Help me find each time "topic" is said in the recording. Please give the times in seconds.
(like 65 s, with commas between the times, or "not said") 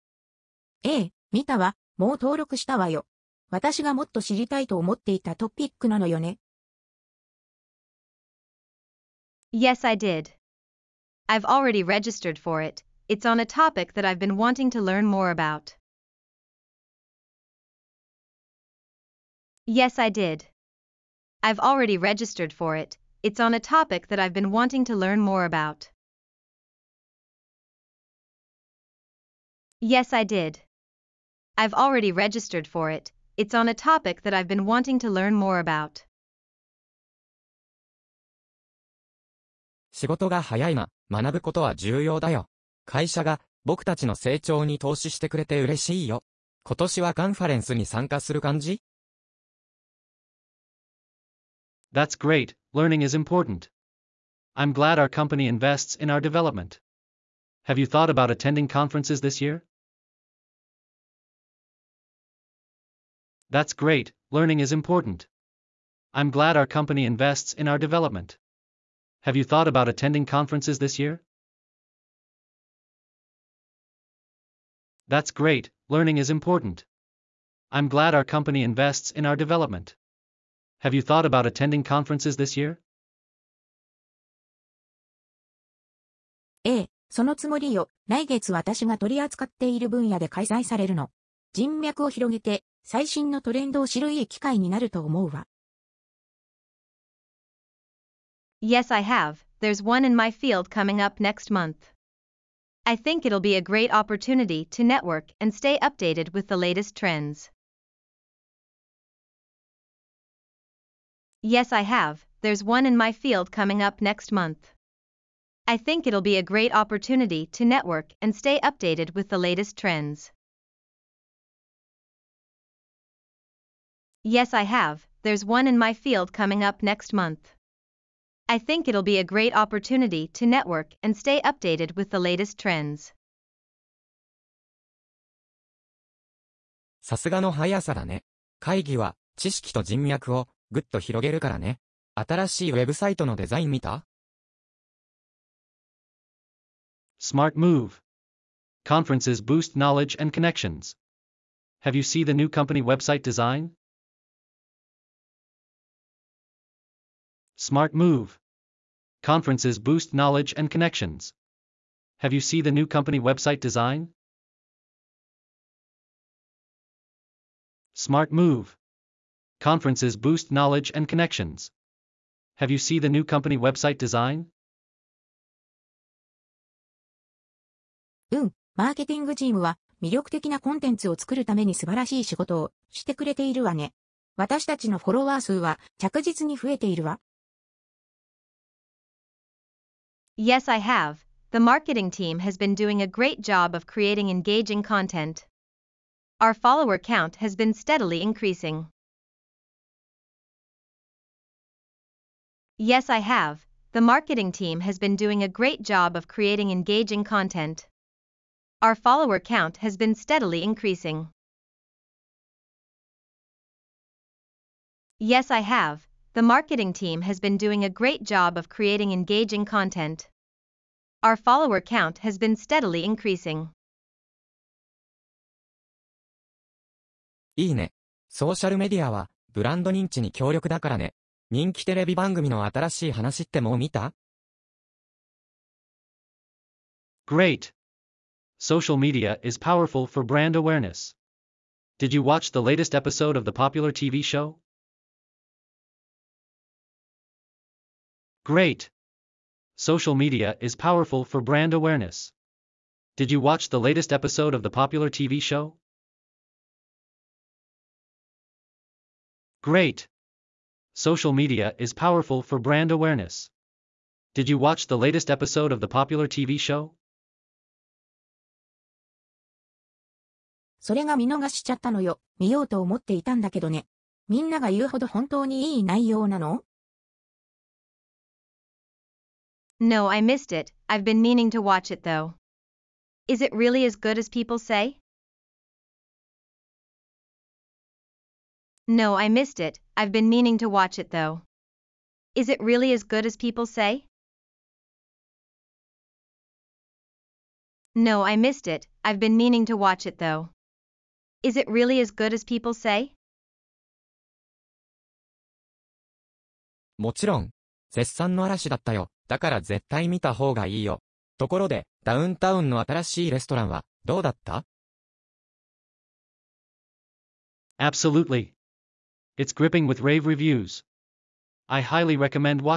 13 s, 23 s, 33 s.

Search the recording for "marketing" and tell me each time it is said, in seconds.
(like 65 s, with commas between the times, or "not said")
191 s, 204 s, 216 s.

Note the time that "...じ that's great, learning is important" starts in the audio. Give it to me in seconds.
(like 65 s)
48 s.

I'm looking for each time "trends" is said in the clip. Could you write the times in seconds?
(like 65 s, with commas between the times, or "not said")
106 s, 119 s, 132 s.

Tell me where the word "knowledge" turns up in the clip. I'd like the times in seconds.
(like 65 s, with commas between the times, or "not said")
149 s, 160 s, 170 s.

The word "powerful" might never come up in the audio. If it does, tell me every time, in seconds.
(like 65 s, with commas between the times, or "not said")
239 s, 250 s, 261 s.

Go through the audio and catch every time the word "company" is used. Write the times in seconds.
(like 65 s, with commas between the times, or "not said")
55 s, 66 s, 78 s, 152 s, 162 s, 173 s.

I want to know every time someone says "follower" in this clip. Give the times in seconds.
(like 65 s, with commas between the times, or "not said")
196 s, 208 s, 221 s.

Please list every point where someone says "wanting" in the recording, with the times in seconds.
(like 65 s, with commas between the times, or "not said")
14 s, 24 s, 34 s.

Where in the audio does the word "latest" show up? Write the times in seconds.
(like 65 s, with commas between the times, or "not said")
106 s, 119 s, 132 s, 242 s, 253 s, 264 s.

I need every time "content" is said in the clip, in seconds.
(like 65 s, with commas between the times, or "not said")
194 s, 207 s, 219 s.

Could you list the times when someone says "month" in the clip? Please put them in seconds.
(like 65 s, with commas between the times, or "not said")
101 s, 114 s, 127 s.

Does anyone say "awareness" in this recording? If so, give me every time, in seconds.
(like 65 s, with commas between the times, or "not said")
240 s, 251 s, 262 s.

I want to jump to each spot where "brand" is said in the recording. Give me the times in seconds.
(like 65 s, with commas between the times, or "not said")
240 s, 251 s, 262 s.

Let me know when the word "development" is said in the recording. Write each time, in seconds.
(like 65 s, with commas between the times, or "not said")
56 s, 67 s, 79 s.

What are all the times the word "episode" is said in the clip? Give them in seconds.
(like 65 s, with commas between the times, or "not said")
242 s, 254 s, 265 s.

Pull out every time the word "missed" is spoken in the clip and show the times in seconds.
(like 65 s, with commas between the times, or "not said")
280 s, 289 s, 298 s.